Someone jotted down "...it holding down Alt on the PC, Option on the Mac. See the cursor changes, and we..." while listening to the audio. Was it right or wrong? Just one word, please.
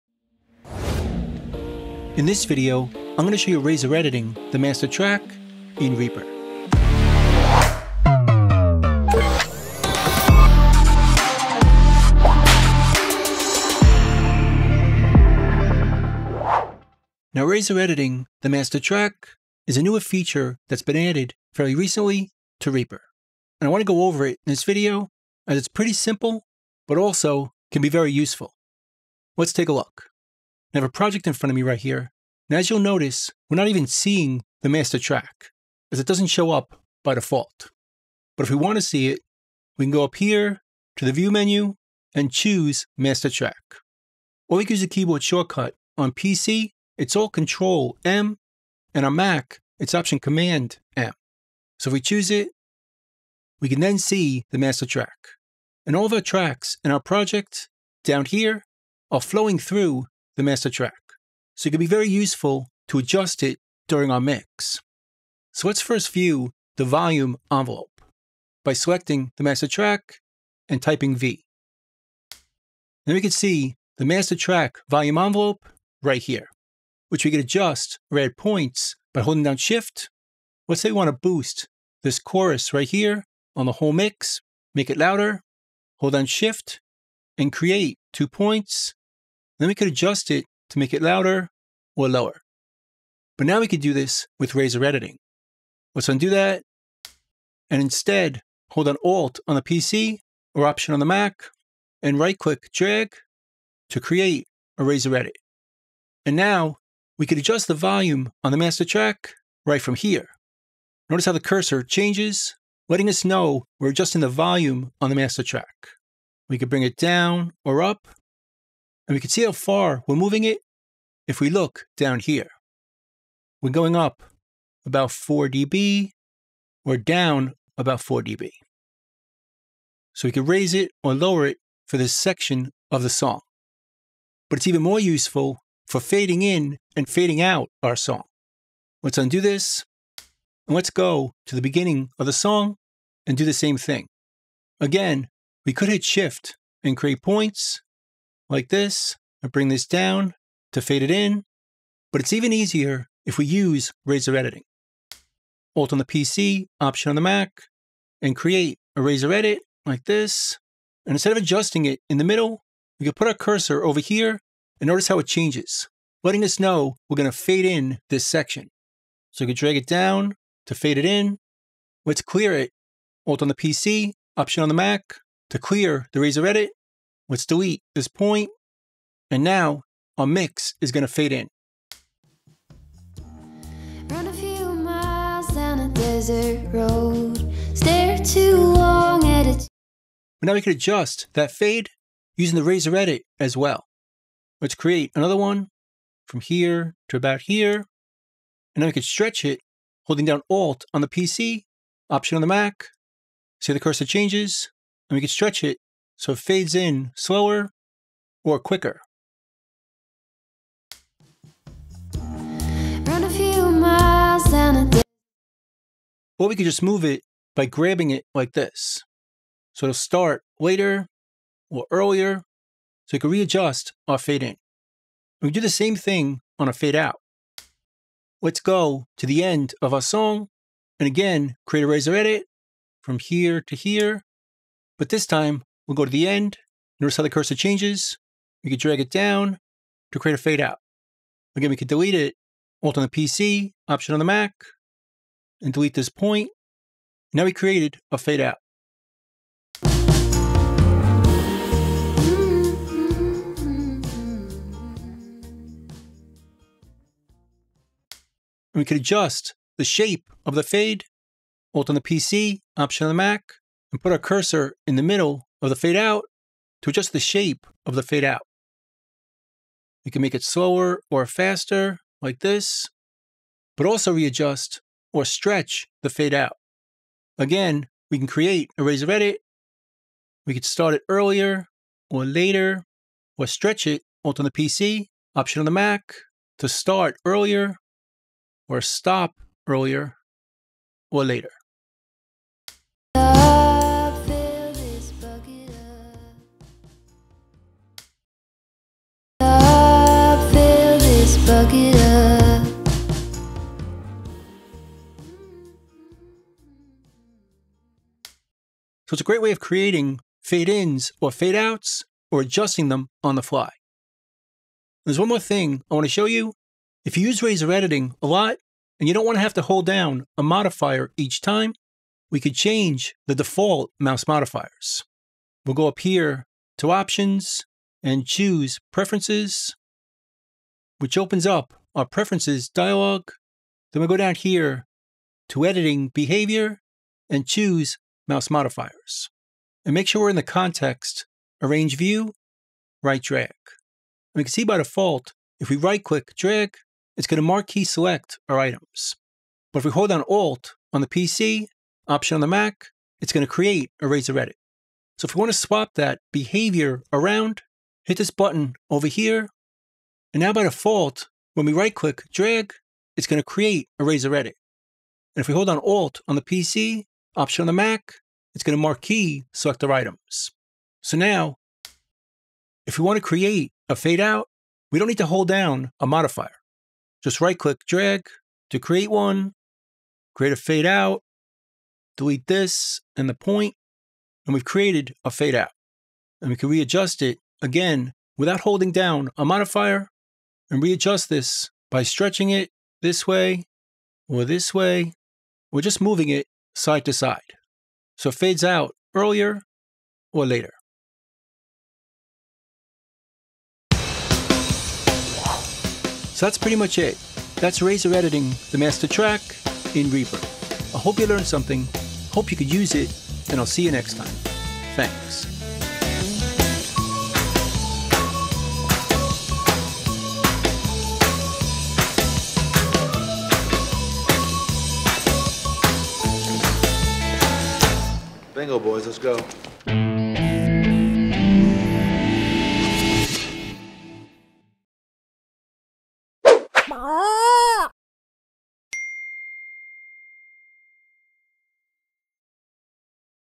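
right.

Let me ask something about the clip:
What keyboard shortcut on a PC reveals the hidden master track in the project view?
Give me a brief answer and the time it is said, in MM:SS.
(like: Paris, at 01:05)
Alt Control M, at 00:47.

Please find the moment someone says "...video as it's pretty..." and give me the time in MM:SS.
00:24.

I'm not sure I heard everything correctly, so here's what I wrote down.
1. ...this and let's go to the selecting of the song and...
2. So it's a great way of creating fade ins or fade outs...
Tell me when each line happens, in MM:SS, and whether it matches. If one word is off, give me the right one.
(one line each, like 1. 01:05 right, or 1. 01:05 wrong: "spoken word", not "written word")
1. 02:19 wrong: "beginning", not "selecting"
2. 05:09 right.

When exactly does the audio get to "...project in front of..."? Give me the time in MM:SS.
00:30.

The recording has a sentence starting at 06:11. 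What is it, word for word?
So now, if we want to create a fade out, we don't need to hold down a modifier.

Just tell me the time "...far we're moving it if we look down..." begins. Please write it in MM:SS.
01:59.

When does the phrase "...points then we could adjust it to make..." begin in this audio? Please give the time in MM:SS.
01:28.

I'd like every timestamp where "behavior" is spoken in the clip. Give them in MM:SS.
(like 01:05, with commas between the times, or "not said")
05:36, 05:56.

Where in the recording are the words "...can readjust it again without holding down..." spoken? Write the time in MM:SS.
06:26.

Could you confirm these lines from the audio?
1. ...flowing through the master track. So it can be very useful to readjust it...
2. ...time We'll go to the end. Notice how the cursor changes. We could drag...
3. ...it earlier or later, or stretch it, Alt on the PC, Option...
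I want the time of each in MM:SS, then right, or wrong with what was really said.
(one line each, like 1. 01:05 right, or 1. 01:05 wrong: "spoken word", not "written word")
1. 00:59 wrong: "adjust", not "readjust"
2. 03:55 right
3. 04:40 right.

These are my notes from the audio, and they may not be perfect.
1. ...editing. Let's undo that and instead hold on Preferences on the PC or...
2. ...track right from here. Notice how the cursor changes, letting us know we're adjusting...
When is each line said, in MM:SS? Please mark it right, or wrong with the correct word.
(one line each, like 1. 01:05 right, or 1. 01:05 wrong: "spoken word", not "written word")
1. 01:34 wrong: "Alt", not "Preferences"
2. 01:48 right.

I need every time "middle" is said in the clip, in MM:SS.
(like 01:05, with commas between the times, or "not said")
02:42, 04:25.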